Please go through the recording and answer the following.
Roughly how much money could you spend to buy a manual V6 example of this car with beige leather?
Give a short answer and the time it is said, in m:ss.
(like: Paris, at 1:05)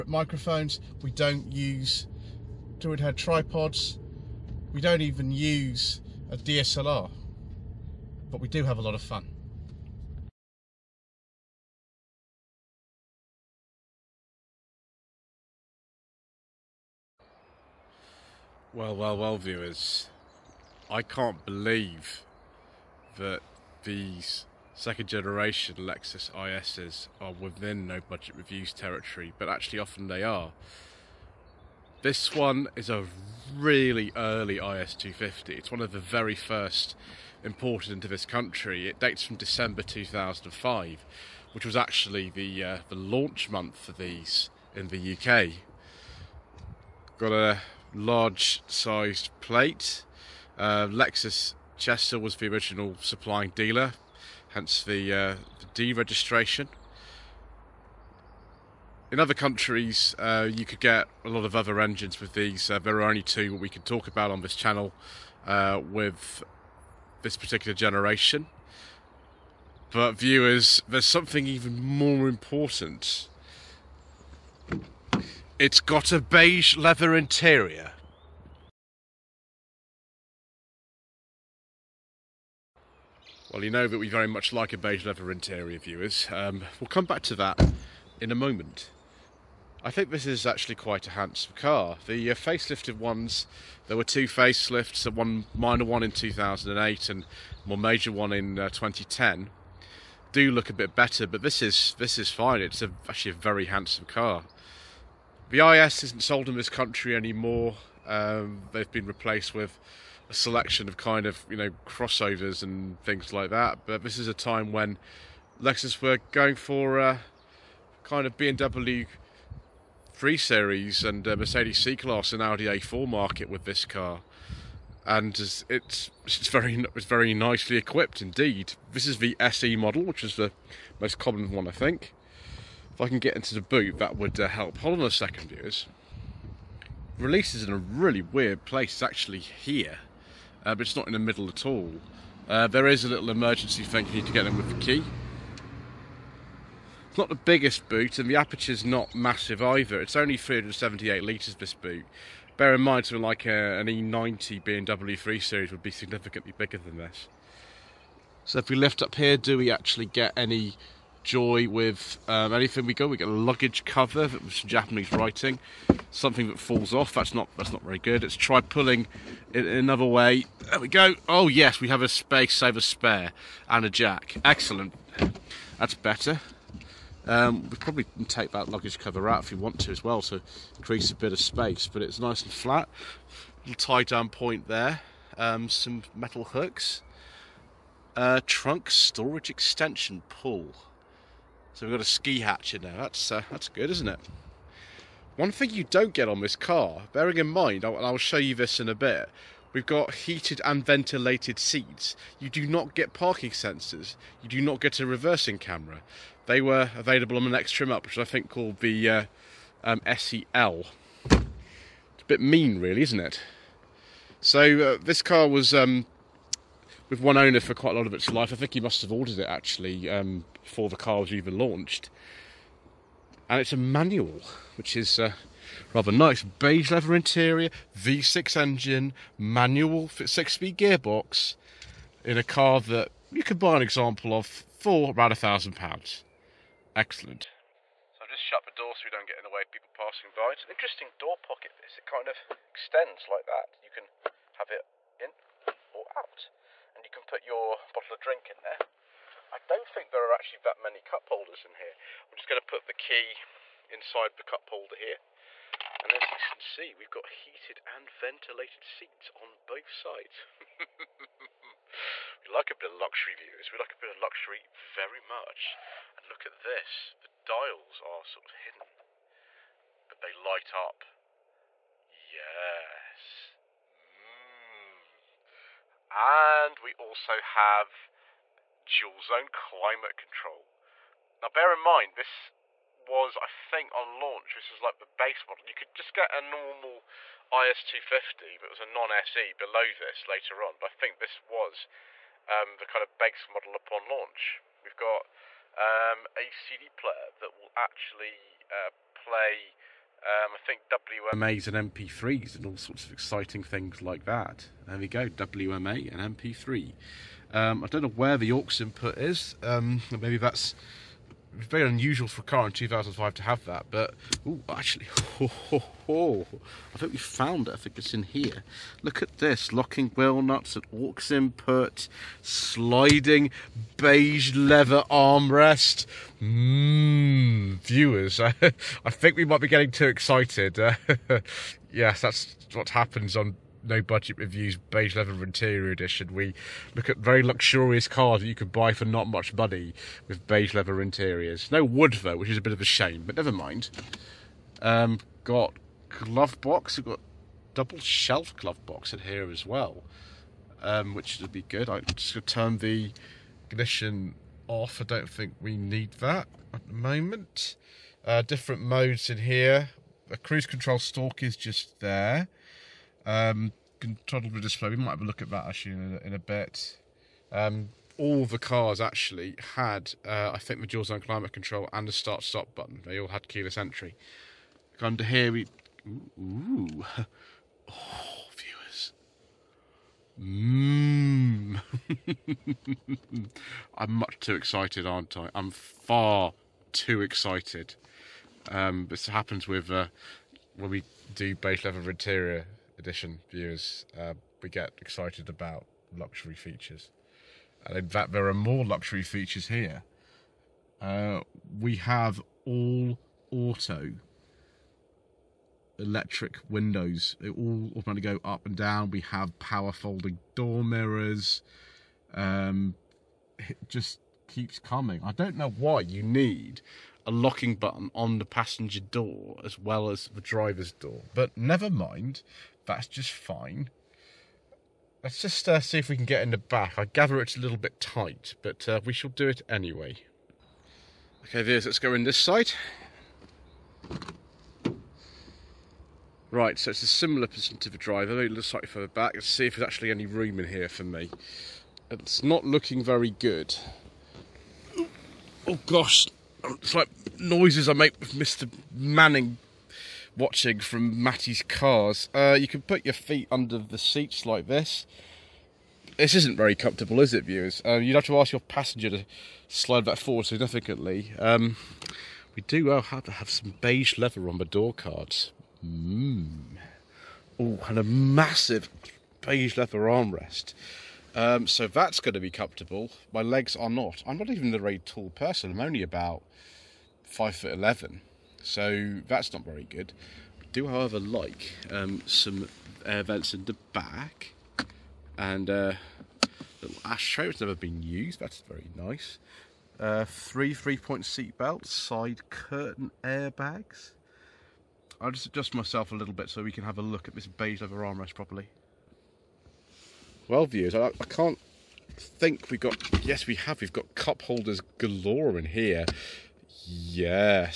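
1000 pounds, at 3:55.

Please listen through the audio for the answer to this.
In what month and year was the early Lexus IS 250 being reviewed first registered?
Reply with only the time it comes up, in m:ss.
0:39.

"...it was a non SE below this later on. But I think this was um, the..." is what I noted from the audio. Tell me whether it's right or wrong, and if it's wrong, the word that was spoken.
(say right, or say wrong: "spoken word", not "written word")
right.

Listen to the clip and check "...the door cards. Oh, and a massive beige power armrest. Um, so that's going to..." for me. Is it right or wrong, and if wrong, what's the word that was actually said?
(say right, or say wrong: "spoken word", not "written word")
wrong: "leather", not "power".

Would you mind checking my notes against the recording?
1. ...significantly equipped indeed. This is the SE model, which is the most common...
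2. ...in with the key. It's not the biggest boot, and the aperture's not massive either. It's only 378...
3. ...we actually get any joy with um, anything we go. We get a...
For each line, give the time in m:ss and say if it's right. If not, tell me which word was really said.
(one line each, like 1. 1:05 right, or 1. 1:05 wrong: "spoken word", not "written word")
1. 2:07 wrong: "nicely", not "significantly"
2. 2:24 right
3. 2:39 right.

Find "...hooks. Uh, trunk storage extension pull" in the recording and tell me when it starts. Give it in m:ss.
3:06.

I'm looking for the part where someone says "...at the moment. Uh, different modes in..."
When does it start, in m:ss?
5:56.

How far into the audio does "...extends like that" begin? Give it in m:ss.
4:02.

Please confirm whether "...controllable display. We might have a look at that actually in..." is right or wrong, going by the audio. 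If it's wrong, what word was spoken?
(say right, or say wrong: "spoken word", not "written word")
right.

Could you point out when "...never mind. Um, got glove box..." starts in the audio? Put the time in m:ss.
5:43.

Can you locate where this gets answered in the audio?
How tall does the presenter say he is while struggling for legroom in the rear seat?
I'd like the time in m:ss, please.
7:57.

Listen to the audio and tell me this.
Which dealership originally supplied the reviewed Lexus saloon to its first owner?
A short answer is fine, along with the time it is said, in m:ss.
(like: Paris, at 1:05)
Lexus Chester, at 0:50.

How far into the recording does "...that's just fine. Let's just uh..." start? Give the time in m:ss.
7:02.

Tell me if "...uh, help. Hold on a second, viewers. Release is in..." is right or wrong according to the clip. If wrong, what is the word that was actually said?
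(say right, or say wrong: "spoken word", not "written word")
right.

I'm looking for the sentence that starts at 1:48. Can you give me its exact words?
Um, they've been replaced with a selection of kind of you know crossovers and things like that.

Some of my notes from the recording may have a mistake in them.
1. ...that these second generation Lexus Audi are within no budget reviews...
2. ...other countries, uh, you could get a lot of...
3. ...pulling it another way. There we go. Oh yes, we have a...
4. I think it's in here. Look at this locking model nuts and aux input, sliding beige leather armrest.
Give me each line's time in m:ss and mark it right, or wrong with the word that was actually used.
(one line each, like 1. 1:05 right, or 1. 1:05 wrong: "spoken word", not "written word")
1. 0:23 wrong: "ISs", not "Audi"
2. 0:59 right
3. 2:48 right
4. 5:17 wrong: "wheel", not "model".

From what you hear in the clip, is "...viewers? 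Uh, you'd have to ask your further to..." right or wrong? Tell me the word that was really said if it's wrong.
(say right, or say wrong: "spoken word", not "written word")
wrong: "passenger", not "further".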